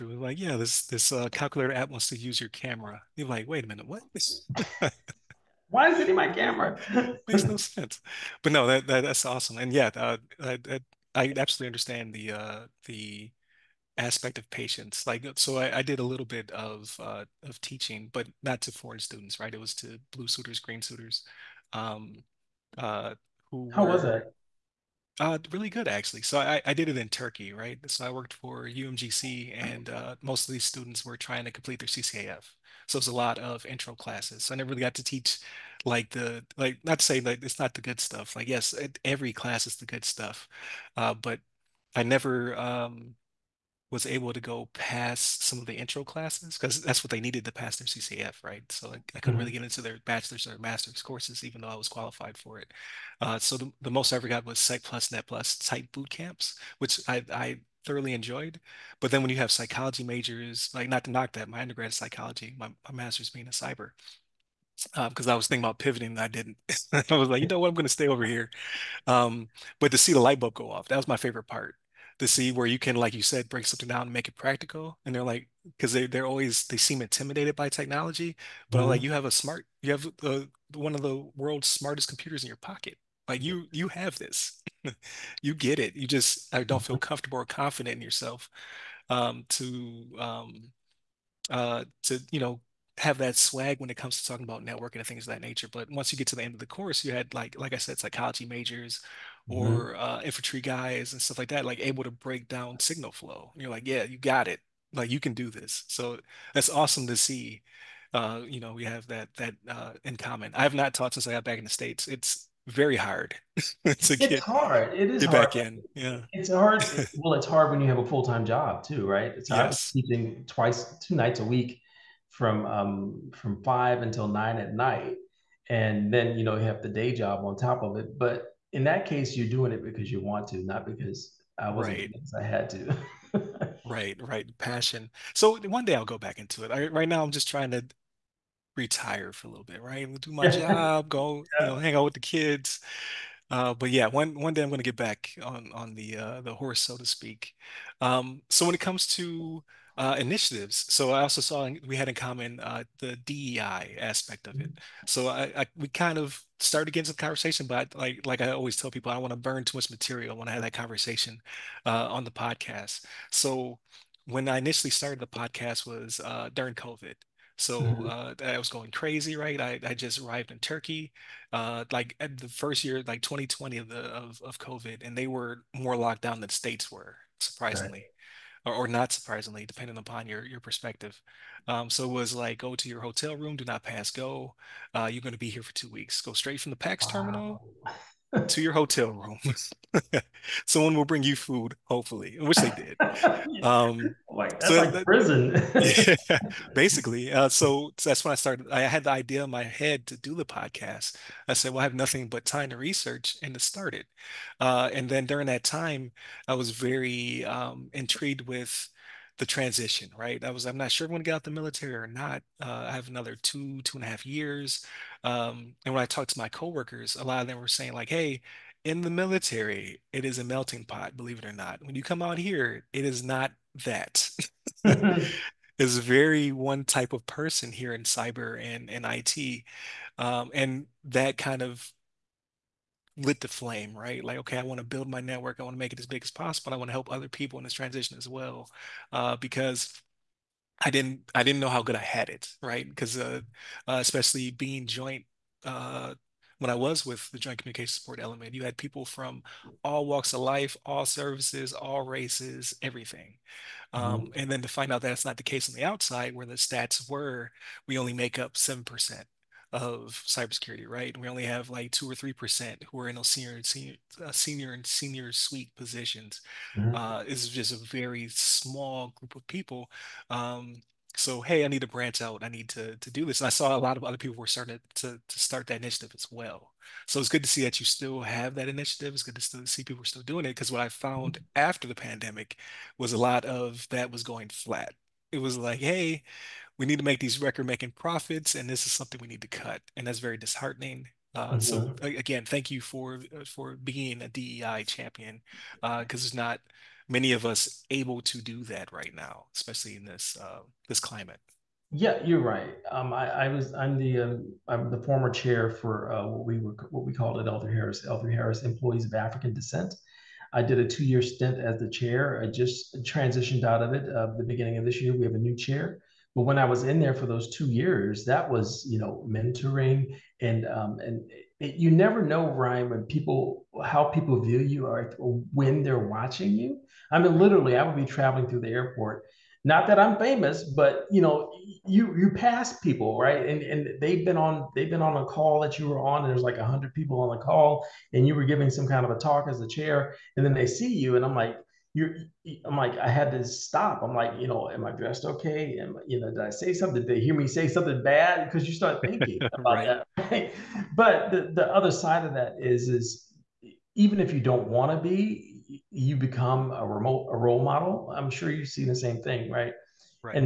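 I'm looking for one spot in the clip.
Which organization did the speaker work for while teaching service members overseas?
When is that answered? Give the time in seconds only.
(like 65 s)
28 s.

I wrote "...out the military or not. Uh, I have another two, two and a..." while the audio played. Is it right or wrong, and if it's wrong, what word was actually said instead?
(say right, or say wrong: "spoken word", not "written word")
right.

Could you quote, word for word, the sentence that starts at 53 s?
Uh, so the, the, most I ever got was Sec Plus, Net Plus type boot camps, which I, I thoroughly enjoyed.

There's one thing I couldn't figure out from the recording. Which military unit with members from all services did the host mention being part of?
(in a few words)
Joint Communication Support Element.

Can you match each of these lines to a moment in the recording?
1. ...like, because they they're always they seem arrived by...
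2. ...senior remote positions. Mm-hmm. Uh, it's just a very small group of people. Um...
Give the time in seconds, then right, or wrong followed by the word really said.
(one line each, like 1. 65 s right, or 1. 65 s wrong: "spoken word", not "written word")
1. 75 s wrong: "intimidated", not "arrived"
2. 264 s wrong: "suite", not "remote".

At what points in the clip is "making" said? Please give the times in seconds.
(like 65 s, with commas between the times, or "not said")
287 s.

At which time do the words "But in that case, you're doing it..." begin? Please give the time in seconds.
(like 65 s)
128 s.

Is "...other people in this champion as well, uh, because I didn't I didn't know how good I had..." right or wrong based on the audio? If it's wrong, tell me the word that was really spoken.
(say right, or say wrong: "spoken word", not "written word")
wrong: "transition", not "champion".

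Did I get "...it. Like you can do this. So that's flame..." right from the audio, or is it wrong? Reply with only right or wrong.
wrong.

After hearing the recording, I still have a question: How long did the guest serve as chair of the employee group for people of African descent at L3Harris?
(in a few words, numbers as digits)
2 years.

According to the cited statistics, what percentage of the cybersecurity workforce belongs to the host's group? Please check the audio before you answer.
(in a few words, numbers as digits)
7%.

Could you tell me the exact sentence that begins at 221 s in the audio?
When you come out here, it is not that.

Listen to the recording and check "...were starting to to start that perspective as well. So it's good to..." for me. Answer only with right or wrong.
wrong.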